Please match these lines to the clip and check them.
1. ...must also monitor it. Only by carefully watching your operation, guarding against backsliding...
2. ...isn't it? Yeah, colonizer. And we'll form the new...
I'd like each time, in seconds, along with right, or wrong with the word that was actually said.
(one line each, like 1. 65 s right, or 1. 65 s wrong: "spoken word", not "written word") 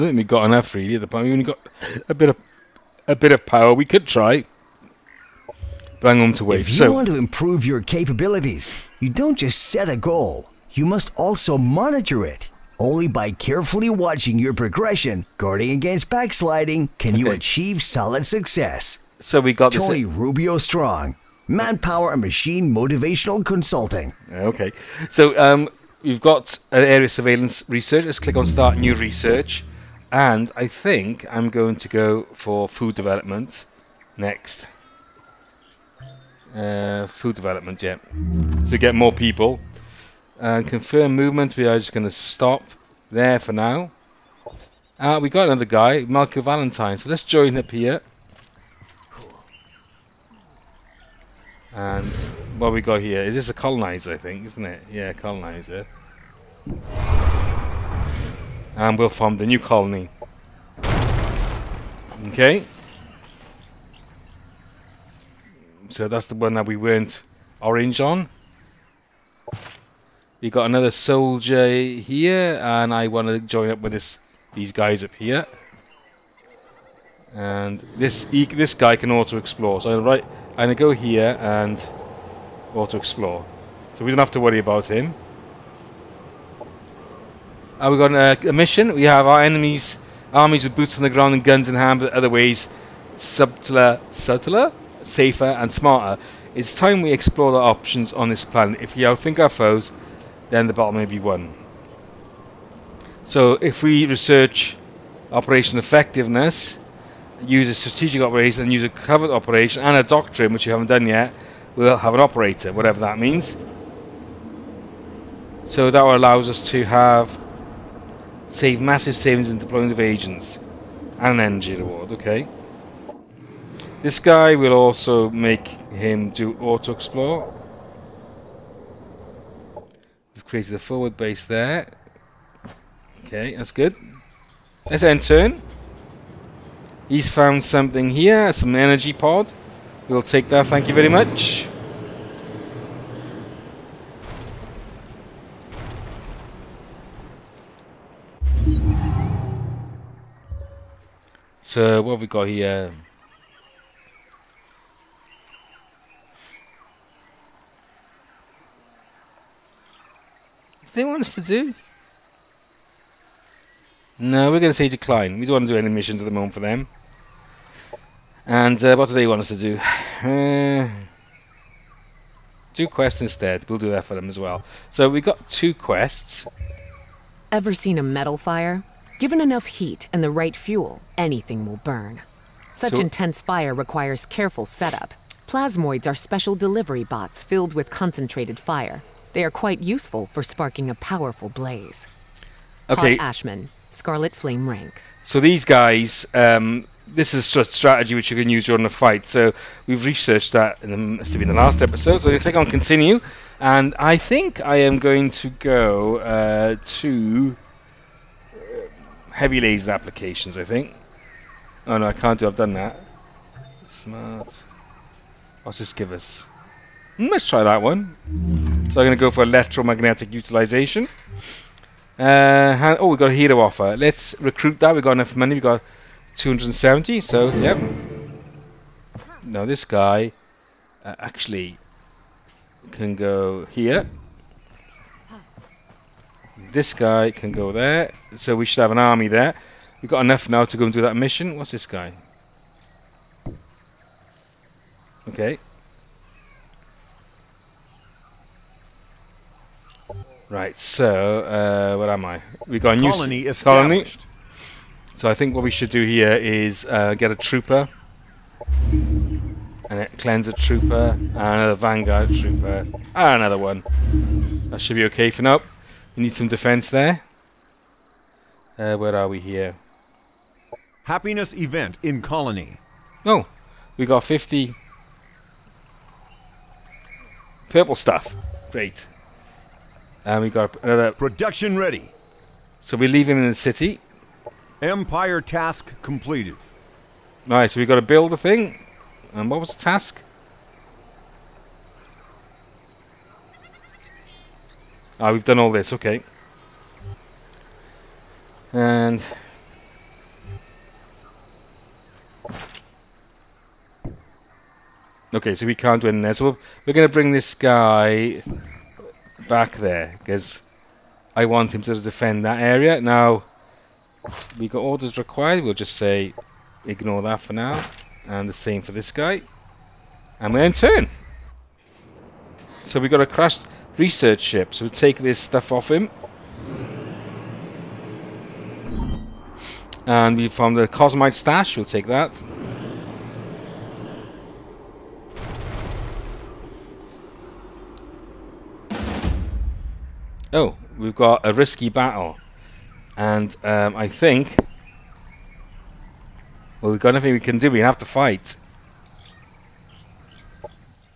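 1. 10 s wrong: "progression", not "operation"
2. 54 s right.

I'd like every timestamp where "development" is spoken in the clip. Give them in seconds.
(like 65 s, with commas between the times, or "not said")
32 s, 37 s.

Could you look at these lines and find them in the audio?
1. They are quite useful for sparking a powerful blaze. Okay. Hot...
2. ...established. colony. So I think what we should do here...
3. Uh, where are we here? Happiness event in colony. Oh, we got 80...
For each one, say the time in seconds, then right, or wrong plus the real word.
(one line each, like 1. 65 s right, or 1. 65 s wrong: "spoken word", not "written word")
1. 189 s right
2. 253 s right
3. 268 s wrong: "50", not "80".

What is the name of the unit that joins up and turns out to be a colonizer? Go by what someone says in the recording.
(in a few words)
Malcolm Valentine.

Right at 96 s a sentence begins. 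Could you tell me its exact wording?
It's time we explore the options on this planet.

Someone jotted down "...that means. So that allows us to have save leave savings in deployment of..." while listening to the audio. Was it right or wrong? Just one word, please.
wrong.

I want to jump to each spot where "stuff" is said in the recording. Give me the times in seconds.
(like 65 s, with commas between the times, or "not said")
277 s, 325 s.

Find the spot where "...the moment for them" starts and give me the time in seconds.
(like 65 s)
166 s.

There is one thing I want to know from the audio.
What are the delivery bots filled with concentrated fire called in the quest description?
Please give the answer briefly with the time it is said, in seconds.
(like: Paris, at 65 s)
Plasmoids, at 185 s.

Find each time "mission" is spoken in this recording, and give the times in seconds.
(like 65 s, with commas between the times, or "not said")
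88 s, 165 s, 241 s.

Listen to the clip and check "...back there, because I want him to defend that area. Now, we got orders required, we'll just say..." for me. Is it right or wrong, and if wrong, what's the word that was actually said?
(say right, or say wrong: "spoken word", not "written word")
right.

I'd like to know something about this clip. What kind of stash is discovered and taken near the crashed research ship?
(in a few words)
Cosmite stash.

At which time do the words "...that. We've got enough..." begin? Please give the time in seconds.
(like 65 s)
224 s.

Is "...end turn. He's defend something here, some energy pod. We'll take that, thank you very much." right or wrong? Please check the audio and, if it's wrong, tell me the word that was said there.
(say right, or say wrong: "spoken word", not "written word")
wrong: "found", not "defend".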